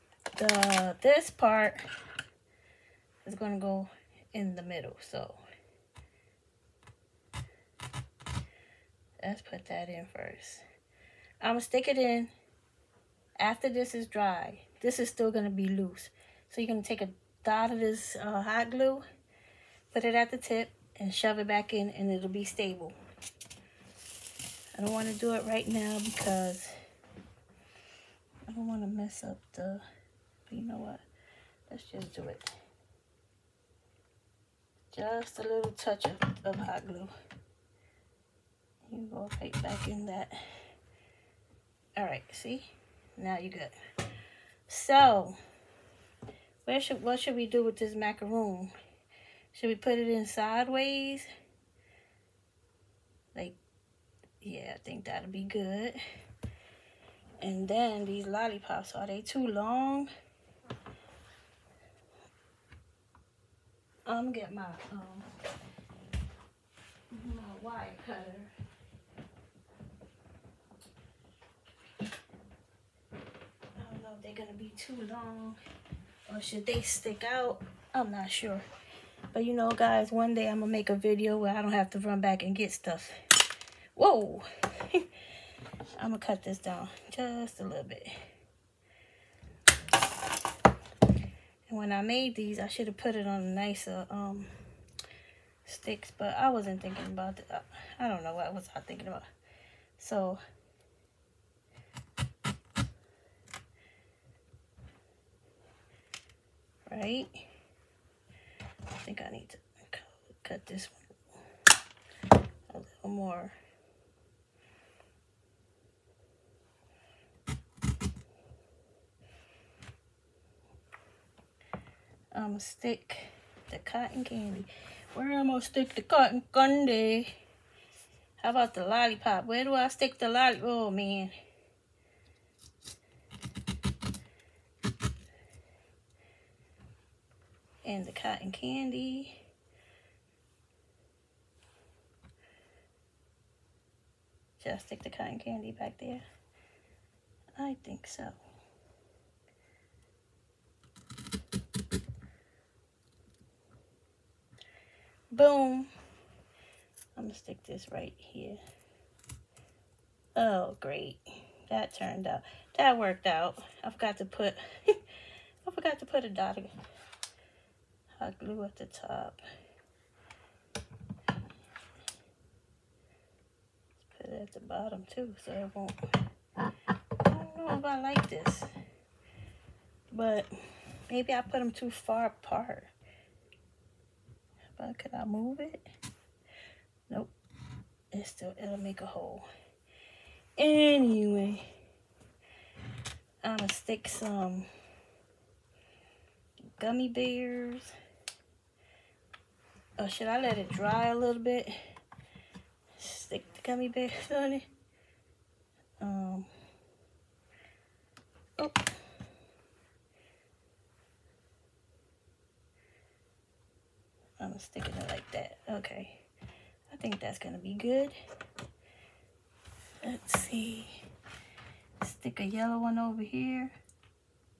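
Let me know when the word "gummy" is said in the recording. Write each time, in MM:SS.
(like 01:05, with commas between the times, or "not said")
03:16, 03:23.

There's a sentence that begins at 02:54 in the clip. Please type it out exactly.
Let's put it at the bottom too, so it won't.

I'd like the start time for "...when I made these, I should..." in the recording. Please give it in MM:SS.
01:31.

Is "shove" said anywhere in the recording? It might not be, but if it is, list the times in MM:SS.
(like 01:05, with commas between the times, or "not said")
00:21.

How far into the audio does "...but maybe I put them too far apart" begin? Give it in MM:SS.
03:00.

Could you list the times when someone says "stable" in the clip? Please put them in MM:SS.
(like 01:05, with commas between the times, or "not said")
00:22.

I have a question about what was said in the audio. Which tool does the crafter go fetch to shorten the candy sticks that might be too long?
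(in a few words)
wire cutter.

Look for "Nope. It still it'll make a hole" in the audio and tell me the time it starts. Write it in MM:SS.
03:07.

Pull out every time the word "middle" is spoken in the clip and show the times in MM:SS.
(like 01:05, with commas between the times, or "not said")
00:04.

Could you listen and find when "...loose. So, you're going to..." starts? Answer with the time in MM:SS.
00:15.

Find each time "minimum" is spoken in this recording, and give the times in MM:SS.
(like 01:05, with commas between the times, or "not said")
not said.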